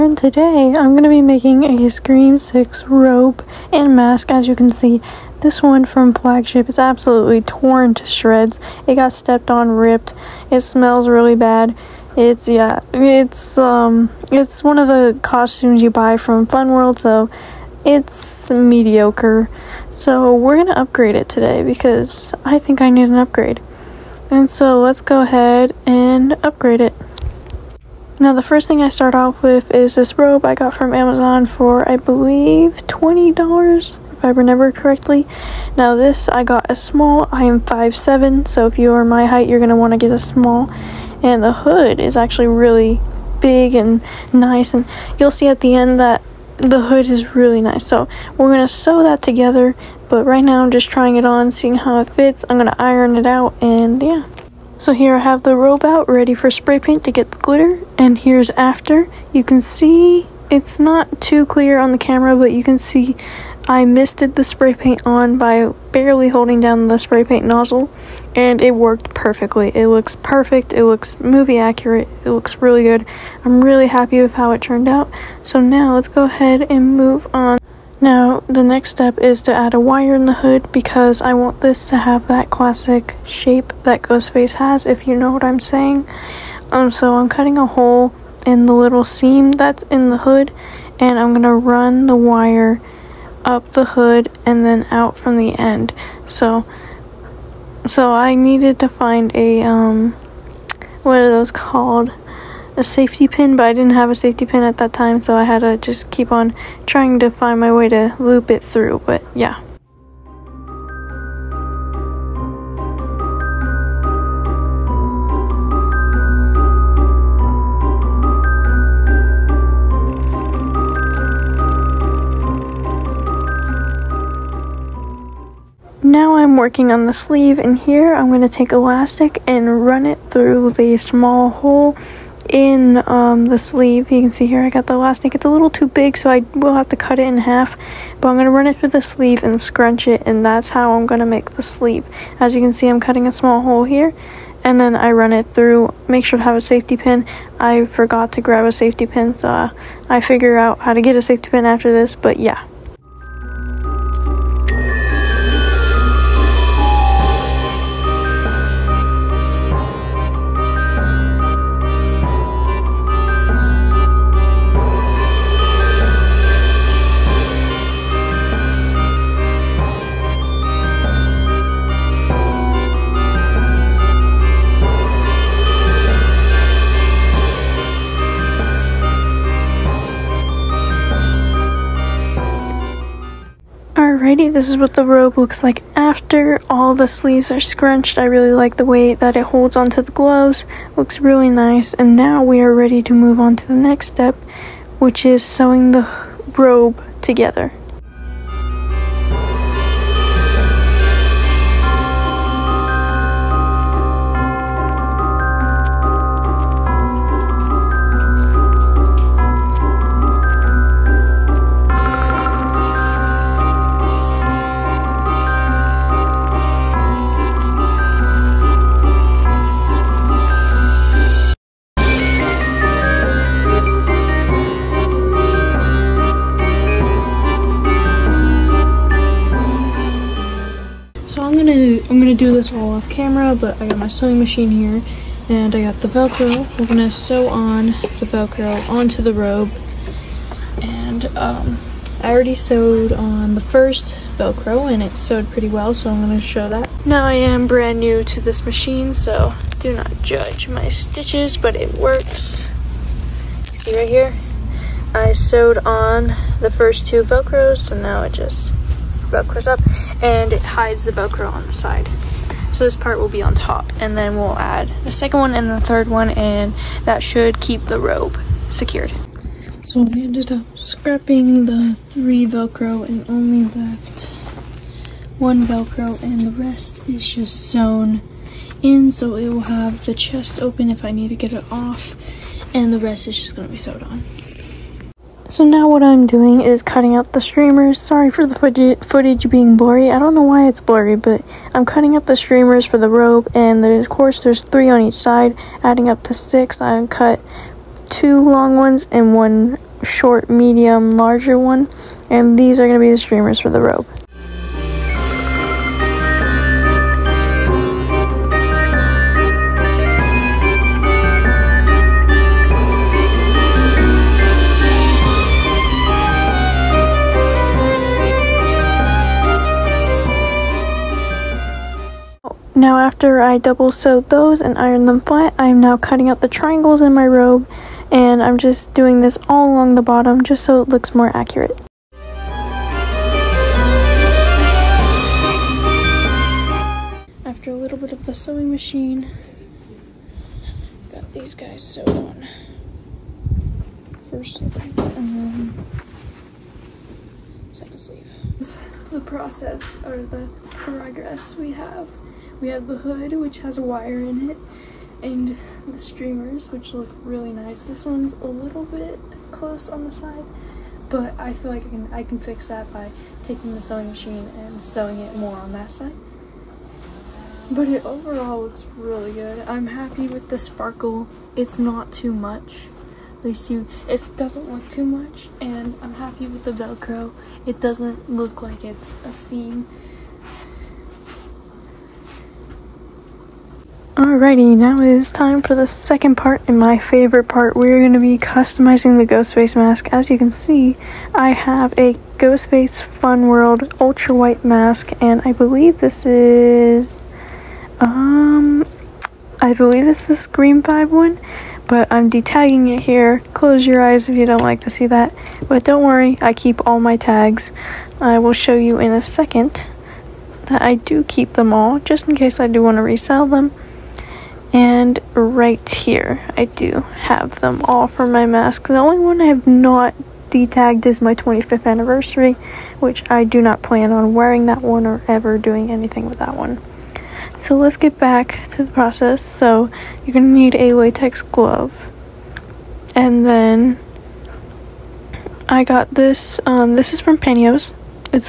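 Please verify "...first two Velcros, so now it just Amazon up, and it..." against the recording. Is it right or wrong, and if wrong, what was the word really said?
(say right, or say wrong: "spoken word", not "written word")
wrong: "Velcros", not "Amazon".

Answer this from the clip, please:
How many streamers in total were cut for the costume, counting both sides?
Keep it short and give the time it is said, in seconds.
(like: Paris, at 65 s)
6, at 296 s.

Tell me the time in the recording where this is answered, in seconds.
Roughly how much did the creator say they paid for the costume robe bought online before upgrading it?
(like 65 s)
32 s.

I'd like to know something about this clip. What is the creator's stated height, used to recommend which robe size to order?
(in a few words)
5'7.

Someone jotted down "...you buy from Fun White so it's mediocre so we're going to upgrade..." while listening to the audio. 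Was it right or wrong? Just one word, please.
wrong.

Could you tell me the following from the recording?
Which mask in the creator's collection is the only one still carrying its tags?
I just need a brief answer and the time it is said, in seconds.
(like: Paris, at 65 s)
25th anniversary, at 421 s.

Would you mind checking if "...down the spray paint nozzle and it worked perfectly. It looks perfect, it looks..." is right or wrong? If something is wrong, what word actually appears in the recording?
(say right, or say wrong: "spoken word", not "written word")
right.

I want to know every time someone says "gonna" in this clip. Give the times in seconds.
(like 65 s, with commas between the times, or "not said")
236 s, 246 s.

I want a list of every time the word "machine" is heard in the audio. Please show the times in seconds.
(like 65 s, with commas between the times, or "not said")
234 s, 248 s, 338 s, 364 s.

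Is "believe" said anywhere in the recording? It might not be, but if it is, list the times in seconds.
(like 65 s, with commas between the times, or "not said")
31 s, 395 s, 399 s.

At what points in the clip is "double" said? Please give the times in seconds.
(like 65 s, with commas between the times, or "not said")
323 s.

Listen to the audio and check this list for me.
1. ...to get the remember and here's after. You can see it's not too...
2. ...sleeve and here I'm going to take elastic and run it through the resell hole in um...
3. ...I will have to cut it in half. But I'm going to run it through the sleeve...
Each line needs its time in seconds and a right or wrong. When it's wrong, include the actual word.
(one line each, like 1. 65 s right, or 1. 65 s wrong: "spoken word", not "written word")
1. 57 s wrong: "glitter", not "remember"
2. 127 s wrong: "small", not "resell"
3. 136 s right.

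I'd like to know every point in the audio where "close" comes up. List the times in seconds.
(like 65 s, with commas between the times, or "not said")
359 s, 403 s.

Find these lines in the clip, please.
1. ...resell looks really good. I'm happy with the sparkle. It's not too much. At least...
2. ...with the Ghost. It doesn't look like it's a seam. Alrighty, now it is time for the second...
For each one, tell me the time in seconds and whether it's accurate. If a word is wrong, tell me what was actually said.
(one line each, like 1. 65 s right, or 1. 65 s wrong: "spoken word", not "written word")
1. 368 s wrong: "overall", not "resell"
2. 376 s wrong: "Velcro", not "Ghost".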